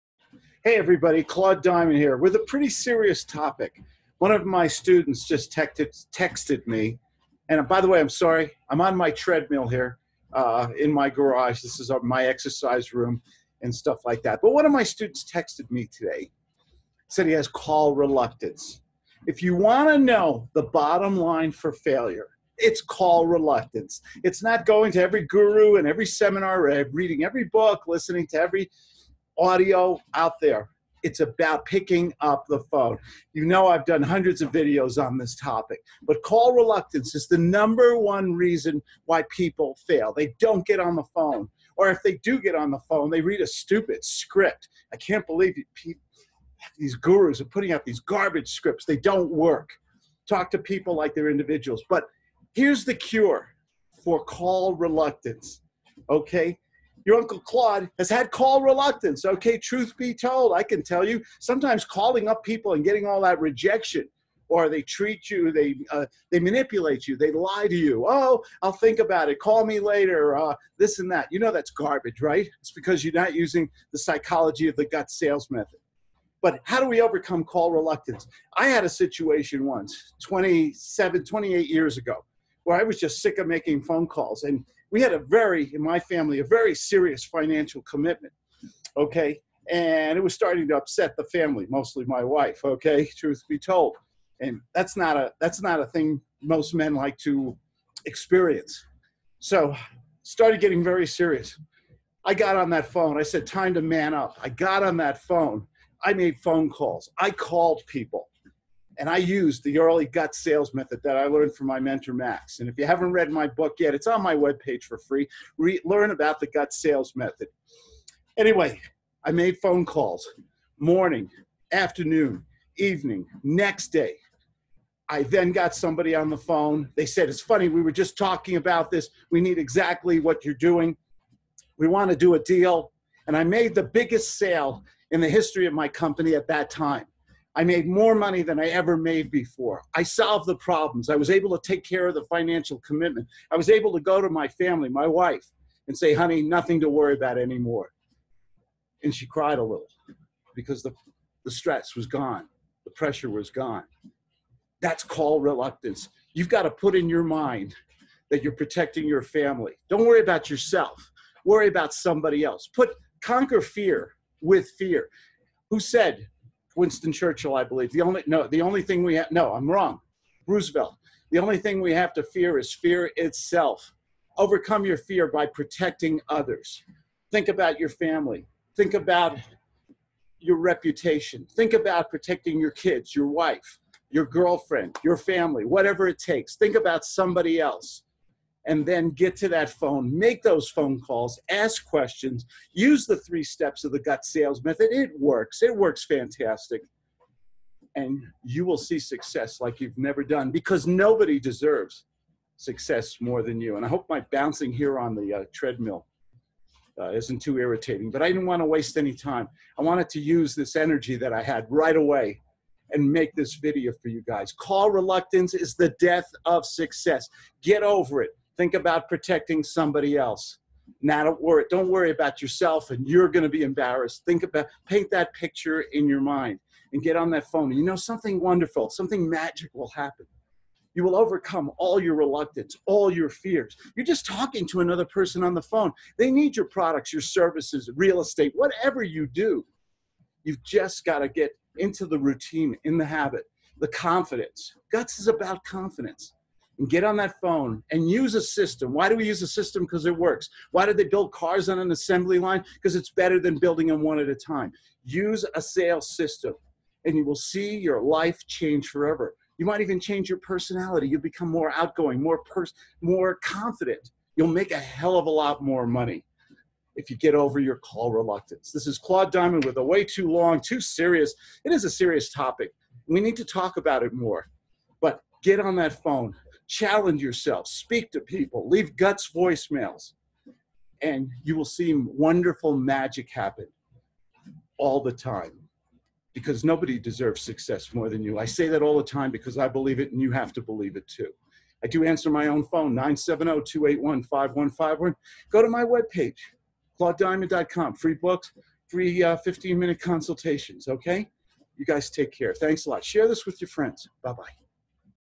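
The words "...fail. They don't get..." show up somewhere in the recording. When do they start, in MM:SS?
00:39.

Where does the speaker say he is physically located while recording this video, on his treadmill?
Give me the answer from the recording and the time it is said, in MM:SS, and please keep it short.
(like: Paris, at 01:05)
garage, at 00:11.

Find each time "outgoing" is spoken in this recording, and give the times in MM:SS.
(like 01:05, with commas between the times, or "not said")
04:21.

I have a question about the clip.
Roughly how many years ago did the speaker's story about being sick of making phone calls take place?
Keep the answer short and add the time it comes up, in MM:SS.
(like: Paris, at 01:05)
27, 28 years, at 01:20.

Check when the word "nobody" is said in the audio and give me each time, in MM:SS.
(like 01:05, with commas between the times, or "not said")
03:20, 04:46.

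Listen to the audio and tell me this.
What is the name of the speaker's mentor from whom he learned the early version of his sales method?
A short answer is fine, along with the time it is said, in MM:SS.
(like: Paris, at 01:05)
Max, at 01:52.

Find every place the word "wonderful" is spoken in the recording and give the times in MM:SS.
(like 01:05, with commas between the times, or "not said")
03:48, 04:41.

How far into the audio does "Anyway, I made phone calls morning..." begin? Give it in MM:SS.
01:58.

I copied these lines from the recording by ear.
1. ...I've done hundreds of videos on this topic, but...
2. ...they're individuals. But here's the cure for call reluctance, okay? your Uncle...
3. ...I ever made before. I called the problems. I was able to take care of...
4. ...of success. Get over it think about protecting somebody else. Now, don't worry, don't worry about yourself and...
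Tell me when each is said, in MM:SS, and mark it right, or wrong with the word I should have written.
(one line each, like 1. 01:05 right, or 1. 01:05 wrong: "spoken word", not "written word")
1. 00:33 right
2. 00:51 right
3. 02:18 wrong: "solved", not "called"
4. 03:36 right.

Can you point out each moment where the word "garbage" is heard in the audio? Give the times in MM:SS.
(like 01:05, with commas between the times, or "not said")
00:48, 01:11.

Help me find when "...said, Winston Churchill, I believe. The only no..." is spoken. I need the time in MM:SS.
02:45.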